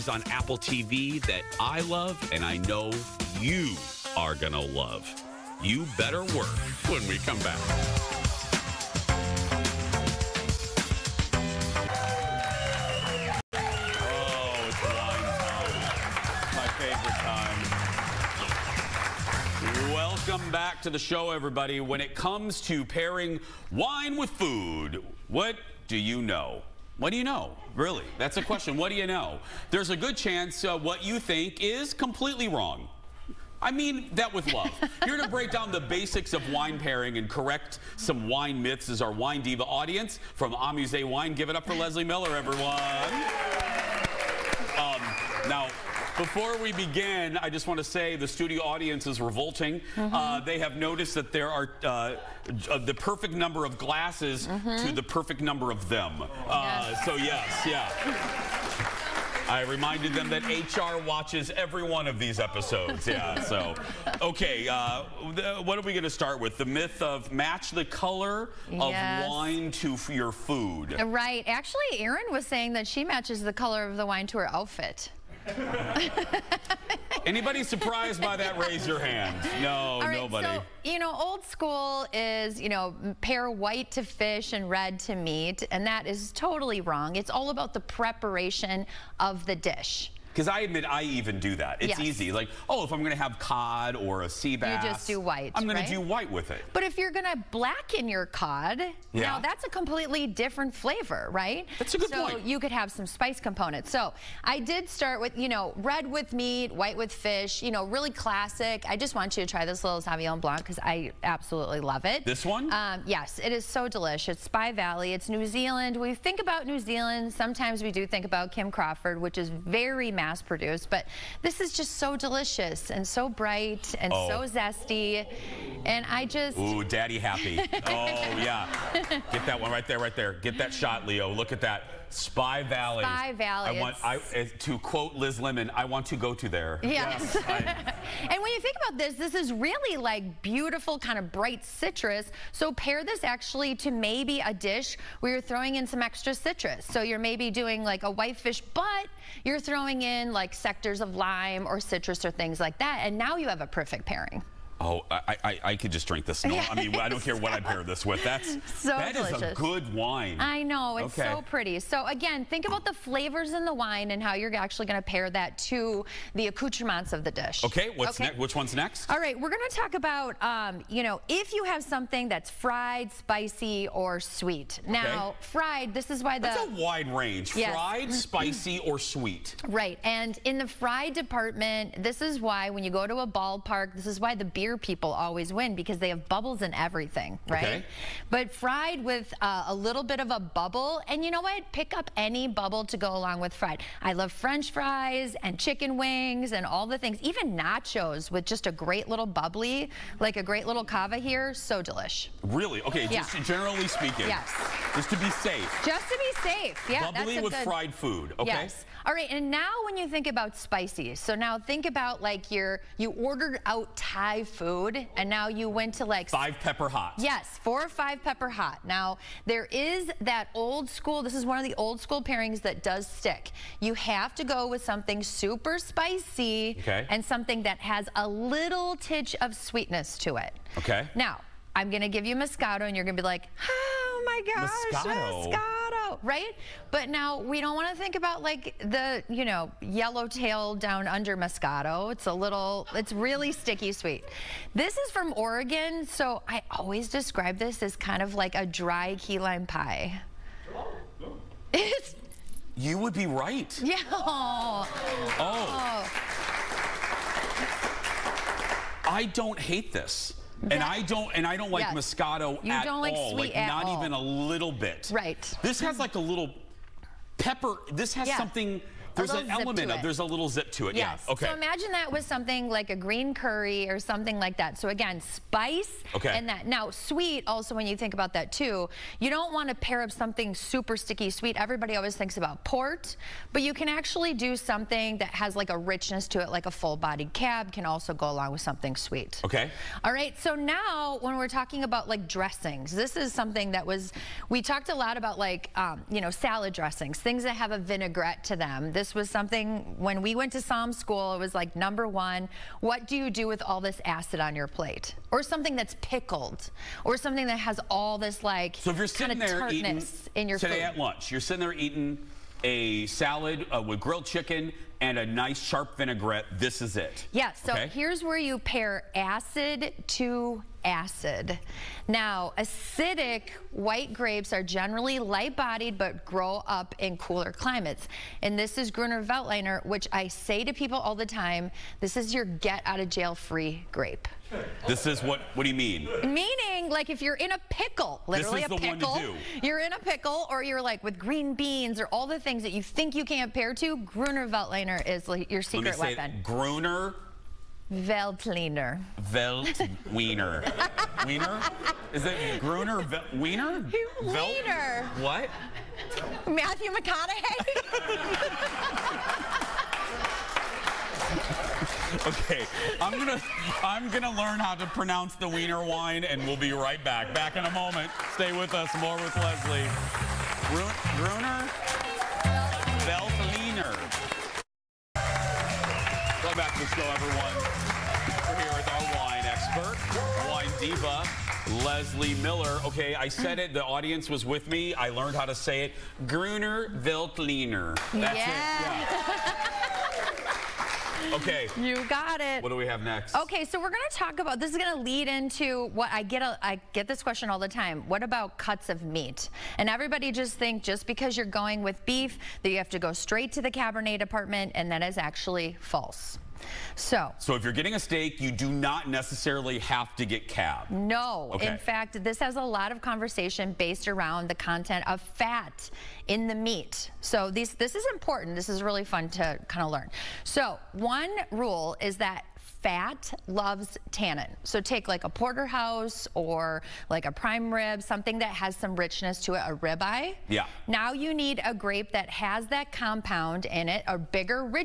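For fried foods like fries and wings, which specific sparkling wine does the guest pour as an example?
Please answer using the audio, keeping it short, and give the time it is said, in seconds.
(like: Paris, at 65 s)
cava, at 200 s.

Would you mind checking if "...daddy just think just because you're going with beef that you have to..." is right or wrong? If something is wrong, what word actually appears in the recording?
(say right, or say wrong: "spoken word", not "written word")
wrong: "everybody", not "daddy".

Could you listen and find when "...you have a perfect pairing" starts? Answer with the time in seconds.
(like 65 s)
153 s.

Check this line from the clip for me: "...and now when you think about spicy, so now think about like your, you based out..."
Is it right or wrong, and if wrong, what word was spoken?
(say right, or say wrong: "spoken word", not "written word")
wrong: "ordered", not "based".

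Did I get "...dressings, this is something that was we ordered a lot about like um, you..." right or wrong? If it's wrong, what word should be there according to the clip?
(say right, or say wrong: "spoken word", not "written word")
wrong: "talked", not "ordered".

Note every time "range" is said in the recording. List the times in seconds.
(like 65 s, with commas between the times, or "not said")
177 s.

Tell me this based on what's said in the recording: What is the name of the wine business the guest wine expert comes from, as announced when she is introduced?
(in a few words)
Amuse Wine.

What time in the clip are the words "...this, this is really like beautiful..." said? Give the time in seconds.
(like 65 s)
138 s.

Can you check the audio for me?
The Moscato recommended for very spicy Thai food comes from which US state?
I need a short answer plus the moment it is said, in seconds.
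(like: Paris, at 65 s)
Oregon, at 245 s.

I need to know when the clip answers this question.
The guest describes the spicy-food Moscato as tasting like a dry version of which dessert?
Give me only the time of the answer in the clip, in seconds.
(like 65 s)
249 s.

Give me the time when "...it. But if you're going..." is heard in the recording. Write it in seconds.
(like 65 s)
96 s.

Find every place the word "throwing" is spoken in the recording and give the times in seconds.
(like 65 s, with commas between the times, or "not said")
145 s, 149 s.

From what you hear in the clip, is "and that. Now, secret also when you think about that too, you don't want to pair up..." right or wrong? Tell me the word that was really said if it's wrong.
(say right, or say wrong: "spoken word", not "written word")
wrong: "sweet", not "secret".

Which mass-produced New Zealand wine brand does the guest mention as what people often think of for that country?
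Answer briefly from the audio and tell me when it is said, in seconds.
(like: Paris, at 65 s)
Kim Crawford, at 118 s.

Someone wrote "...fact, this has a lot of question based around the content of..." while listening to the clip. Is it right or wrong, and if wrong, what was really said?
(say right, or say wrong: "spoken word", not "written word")
wrong: "conversation", not "question".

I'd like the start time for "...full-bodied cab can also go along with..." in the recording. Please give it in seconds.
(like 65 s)
286 s.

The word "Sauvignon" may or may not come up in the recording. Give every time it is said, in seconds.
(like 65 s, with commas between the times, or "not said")
110 s.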